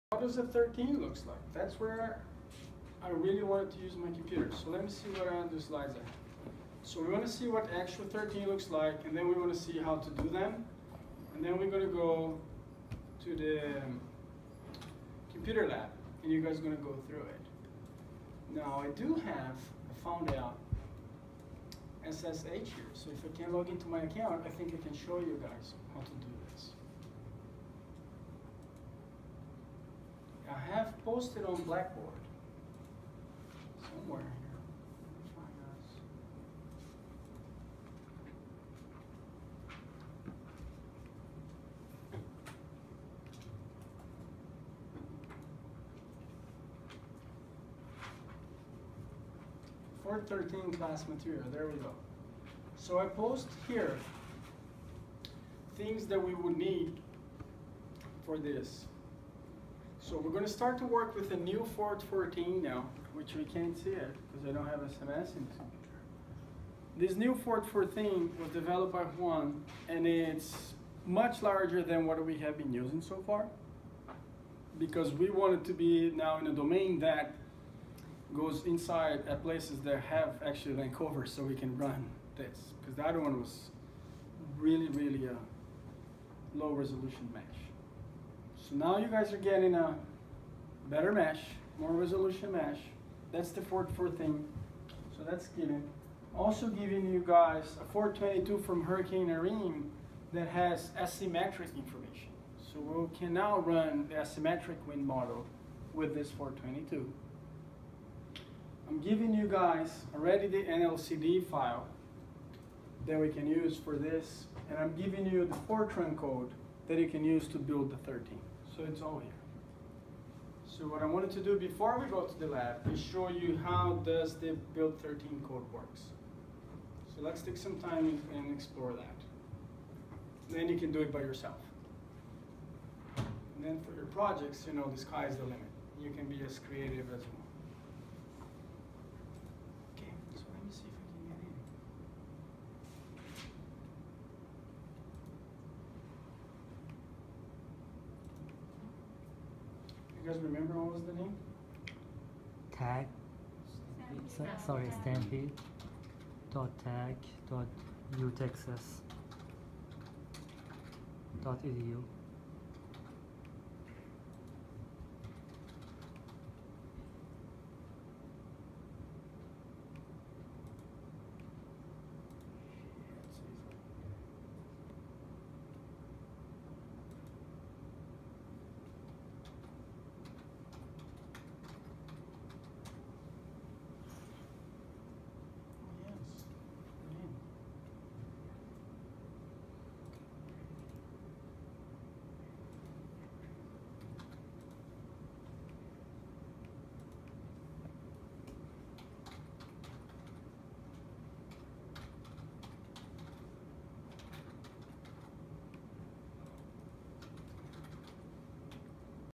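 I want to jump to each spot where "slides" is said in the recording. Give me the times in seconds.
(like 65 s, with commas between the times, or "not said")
5 s.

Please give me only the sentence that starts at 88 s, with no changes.
So now you guys are getting a better mesh, more resolution mesh.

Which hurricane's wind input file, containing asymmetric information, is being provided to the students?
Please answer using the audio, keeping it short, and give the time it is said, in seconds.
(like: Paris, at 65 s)
Hurricane Irene, at 98 s.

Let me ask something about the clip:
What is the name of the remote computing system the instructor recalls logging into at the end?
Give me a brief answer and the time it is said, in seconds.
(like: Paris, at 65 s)
Stampede, at 155 s.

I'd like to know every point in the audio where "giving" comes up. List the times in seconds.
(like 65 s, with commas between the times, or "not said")
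96 s, 109 s, 114 s.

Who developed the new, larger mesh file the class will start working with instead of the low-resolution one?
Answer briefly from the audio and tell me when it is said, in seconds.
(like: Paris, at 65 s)
Juan, at 69 s.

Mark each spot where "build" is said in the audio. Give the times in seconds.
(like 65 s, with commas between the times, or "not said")
117 s, 124 s.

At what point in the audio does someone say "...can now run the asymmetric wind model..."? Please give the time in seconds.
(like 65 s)
103 s.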